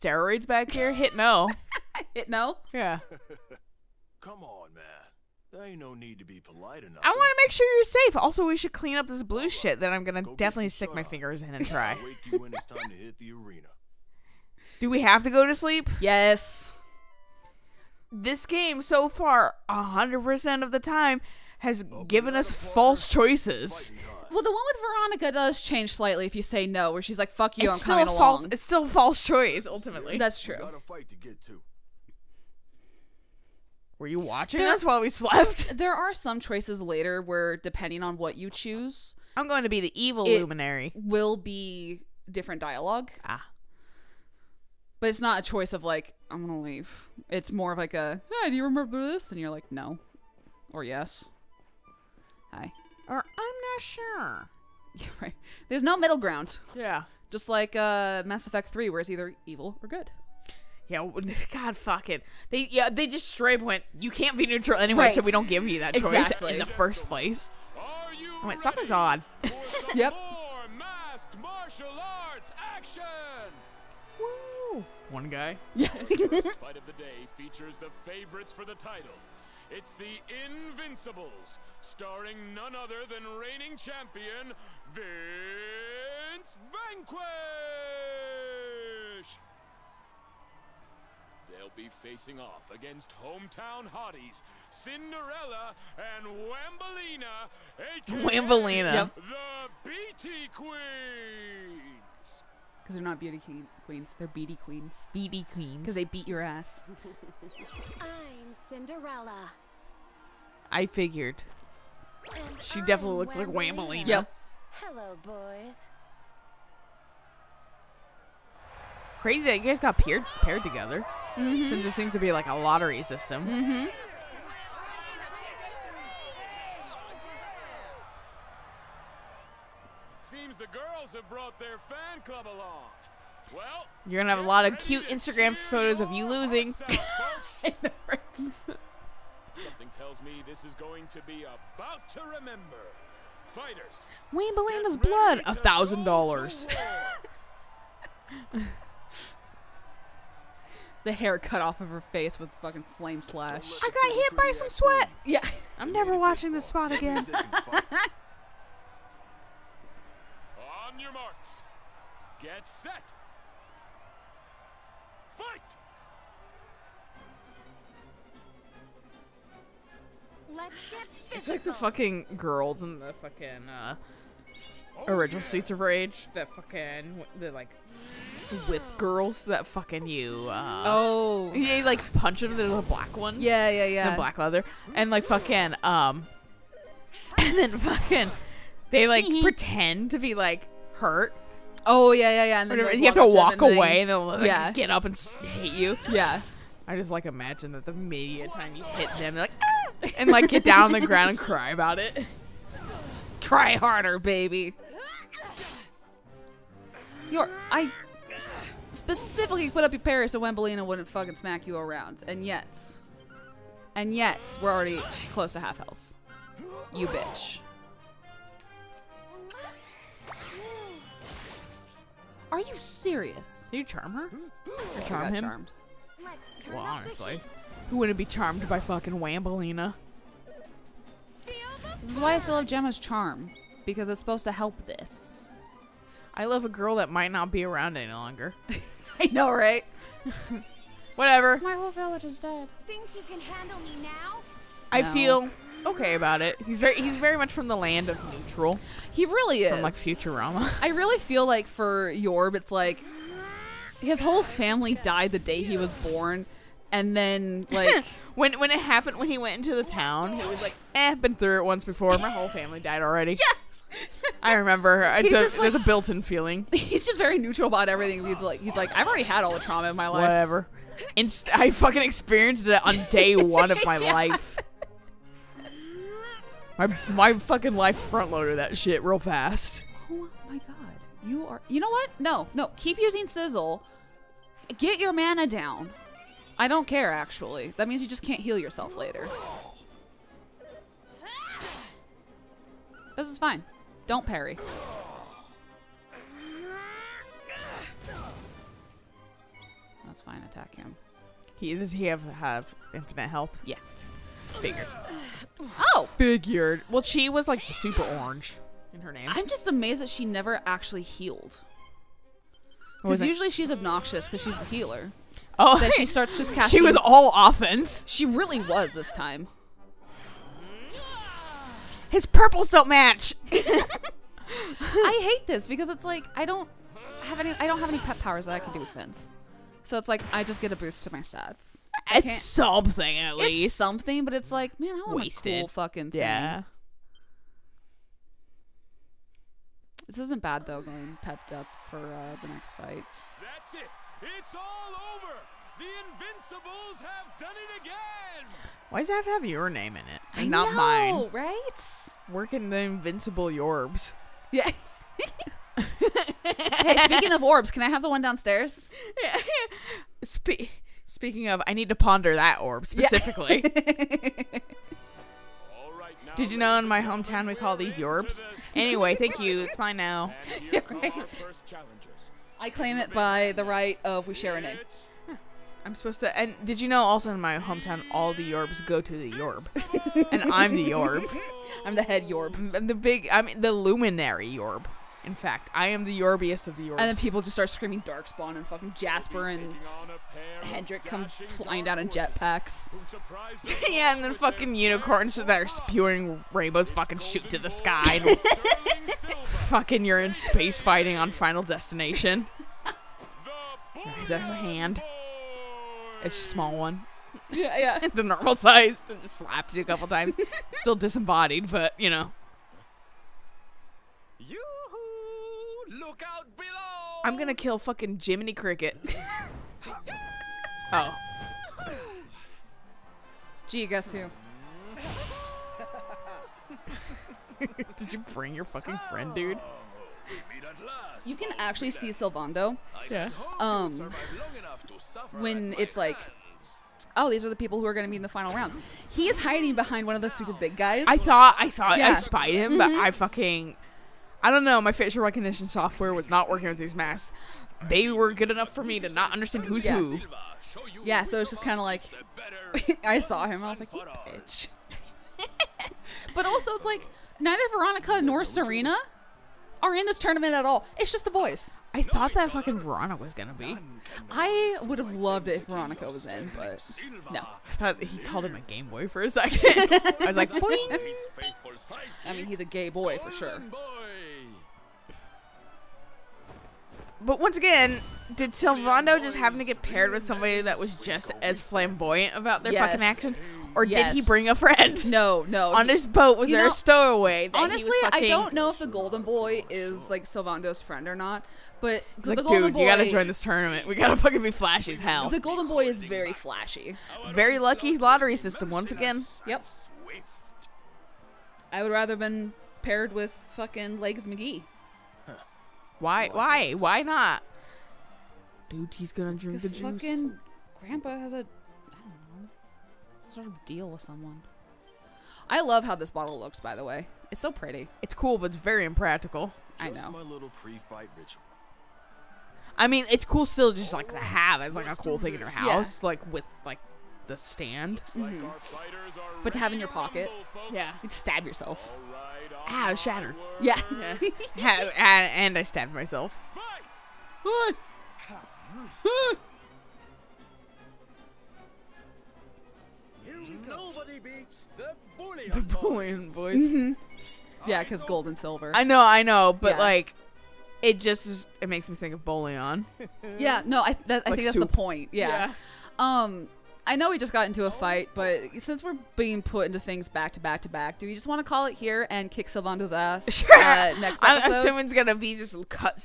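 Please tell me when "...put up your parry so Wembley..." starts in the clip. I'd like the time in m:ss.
3:29.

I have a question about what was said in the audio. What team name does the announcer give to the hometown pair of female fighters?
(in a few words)
The BT Queens.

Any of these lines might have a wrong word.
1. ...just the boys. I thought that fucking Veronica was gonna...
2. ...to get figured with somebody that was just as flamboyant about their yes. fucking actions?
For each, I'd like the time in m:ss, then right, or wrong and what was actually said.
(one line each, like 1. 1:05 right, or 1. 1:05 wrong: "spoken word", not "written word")
1. 7:41 right
2. 7:59 wrong: "paired", not "figured".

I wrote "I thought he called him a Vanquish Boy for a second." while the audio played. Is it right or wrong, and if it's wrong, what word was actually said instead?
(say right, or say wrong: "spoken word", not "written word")
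wrong: "Game", not "Vanquish".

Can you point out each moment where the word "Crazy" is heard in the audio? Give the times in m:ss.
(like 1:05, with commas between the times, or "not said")
1:59.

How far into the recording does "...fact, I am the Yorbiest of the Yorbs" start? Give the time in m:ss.
6:25.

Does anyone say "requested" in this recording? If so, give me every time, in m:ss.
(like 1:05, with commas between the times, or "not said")
not said.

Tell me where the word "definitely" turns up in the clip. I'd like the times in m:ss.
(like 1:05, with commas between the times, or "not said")
0:10, 1:52.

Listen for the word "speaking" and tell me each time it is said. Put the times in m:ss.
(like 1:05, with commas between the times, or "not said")
5:57, 6:01.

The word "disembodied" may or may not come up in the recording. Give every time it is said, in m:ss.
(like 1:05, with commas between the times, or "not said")
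6:50.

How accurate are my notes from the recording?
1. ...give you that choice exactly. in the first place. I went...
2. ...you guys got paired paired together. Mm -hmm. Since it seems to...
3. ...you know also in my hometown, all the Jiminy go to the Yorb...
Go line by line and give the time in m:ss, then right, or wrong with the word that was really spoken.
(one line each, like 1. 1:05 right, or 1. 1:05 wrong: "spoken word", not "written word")
1. 1:05 right
2. 1:59 right
3. 6:16 wrong: "Yorbs", not "Jiminy".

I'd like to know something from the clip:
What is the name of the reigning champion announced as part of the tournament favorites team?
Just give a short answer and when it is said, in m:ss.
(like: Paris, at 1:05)
Vince Vanquish, at 1:24.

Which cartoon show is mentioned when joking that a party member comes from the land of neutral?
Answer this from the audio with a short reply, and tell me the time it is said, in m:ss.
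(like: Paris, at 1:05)
Futurama, at 4:09.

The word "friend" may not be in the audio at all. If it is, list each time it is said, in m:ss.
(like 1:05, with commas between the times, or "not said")
7:09, 8:04, 8:10.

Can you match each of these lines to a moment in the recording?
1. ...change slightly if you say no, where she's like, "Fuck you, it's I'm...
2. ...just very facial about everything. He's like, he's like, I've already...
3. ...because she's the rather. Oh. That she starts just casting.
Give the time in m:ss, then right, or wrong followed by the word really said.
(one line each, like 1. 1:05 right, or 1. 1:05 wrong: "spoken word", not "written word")
1. 0:25 right
2. 4:27 wrong: "neutral", not "facial"
3. 5:14 wrong: "healer", not "rather".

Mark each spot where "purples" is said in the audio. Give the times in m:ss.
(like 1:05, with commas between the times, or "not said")
5:22.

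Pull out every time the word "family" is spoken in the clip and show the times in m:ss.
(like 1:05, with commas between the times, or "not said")
4:14, 4:22.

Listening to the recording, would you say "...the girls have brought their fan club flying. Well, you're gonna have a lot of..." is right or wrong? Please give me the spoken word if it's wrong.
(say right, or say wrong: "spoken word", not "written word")
wrong: "along", not "flying".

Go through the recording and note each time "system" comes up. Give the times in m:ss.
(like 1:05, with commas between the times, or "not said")
2:03, 8:18.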